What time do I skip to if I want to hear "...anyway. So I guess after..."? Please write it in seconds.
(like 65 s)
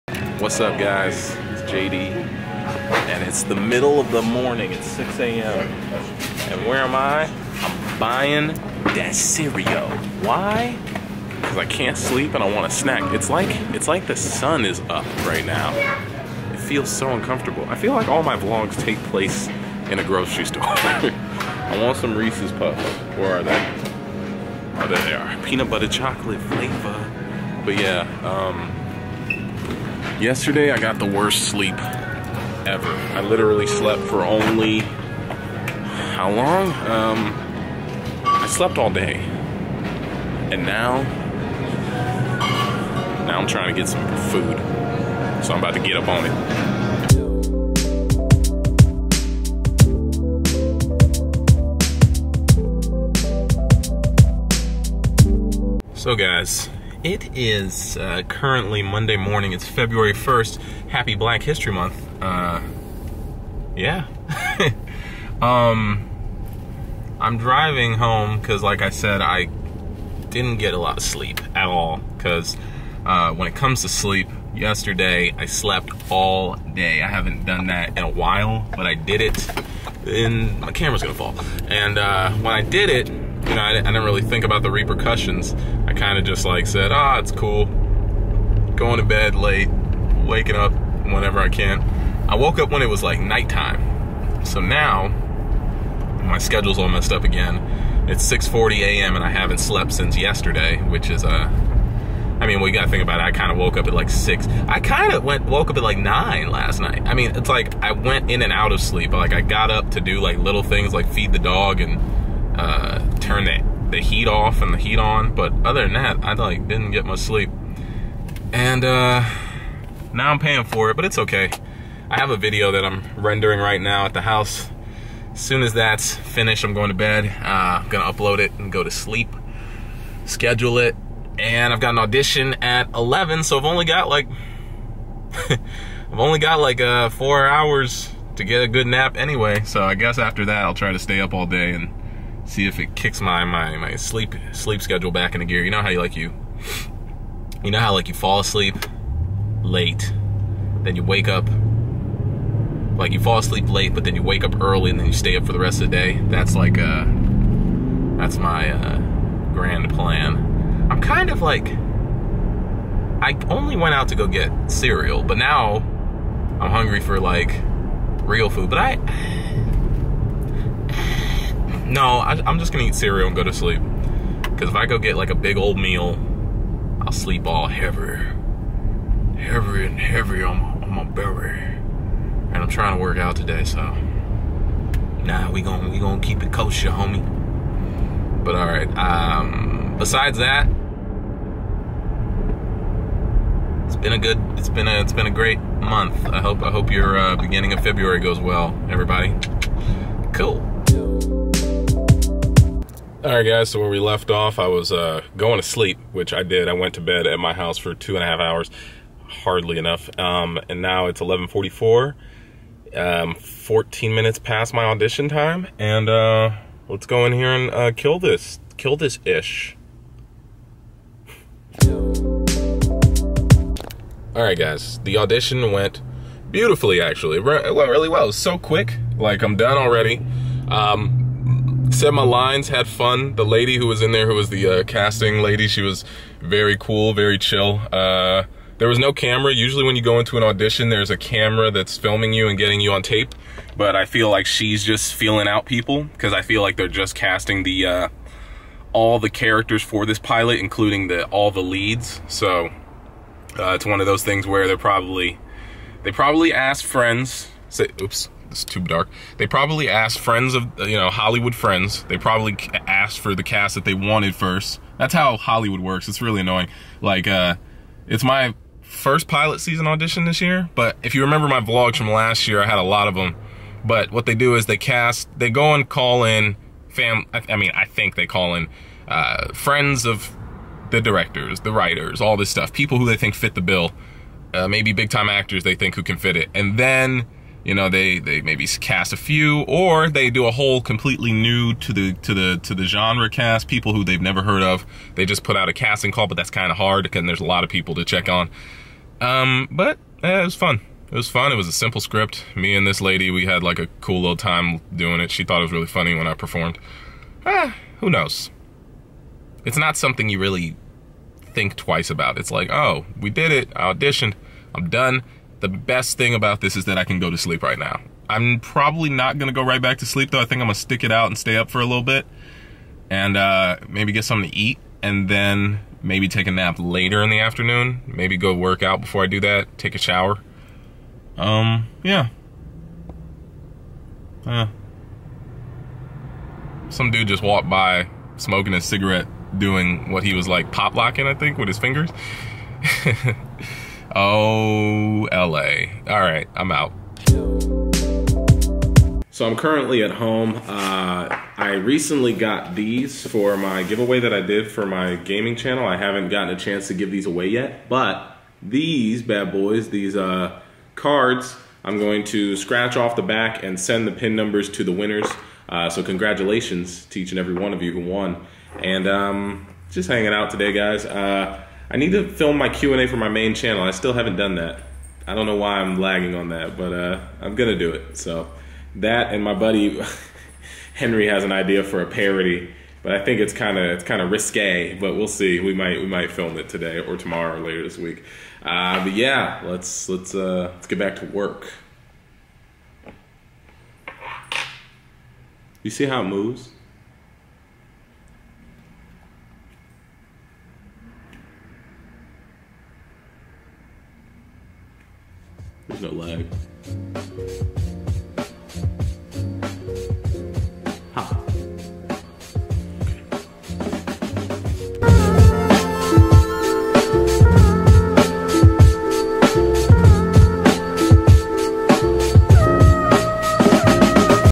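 139 s.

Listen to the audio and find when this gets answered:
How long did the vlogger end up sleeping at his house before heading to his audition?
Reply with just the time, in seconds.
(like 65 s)
207 s.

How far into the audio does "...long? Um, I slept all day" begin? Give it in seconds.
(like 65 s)
36 s.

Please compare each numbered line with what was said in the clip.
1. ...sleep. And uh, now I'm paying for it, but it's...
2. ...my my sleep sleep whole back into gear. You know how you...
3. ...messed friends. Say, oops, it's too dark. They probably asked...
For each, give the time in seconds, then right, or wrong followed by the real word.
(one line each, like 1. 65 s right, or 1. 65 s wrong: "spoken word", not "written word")
1. 117 s right
2. 143 s wrong: "schedule", not "whole"
3. 256 s wrong: "asked", not "messed".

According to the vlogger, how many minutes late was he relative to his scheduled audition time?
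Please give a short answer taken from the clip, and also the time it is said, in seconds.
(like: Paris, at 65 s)
14 minutes, at 213 s.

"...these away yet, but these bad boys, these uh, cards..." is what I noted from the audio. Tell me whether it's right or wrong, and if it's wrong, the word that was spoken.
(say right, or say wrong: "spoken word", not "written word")
right.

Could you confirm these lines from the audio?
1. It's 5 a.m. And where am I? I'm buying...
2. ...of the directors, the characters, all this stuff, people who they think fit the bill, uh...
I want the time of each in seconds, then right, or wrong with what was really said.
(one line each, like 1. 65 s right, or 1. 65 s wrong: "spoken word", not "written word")
1. 4 s wrong: "6", not "5"
2. 280 s wrong: "writers", not "characters".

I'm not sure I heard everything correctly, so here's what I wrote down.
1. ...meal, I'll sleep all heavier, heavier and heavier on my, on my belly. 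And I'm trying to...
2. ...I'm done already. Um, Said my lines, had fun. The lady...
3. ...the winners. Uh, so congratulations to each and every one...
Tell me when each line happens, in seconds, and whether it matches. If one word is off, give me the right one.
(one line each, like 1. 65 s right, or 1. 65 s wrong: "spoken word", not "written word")
1. 175 s right
2. 229 s right
3. 364 s right.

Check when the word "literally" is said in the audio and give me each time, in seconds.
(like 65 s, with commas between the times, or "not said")
33 s.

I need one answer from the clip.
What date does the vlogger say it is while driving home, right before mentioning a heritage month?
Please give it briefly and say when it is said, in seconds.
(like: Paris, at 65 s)
February 1st, at 59 s.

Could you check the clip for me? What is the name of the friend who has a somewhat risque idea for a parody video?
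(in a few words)
Henry.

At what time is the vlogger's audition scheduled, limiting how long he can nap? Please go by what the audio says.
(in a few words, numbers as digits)
11.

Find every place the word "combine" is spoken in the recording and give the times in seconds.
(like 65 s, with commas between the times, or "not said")
not said.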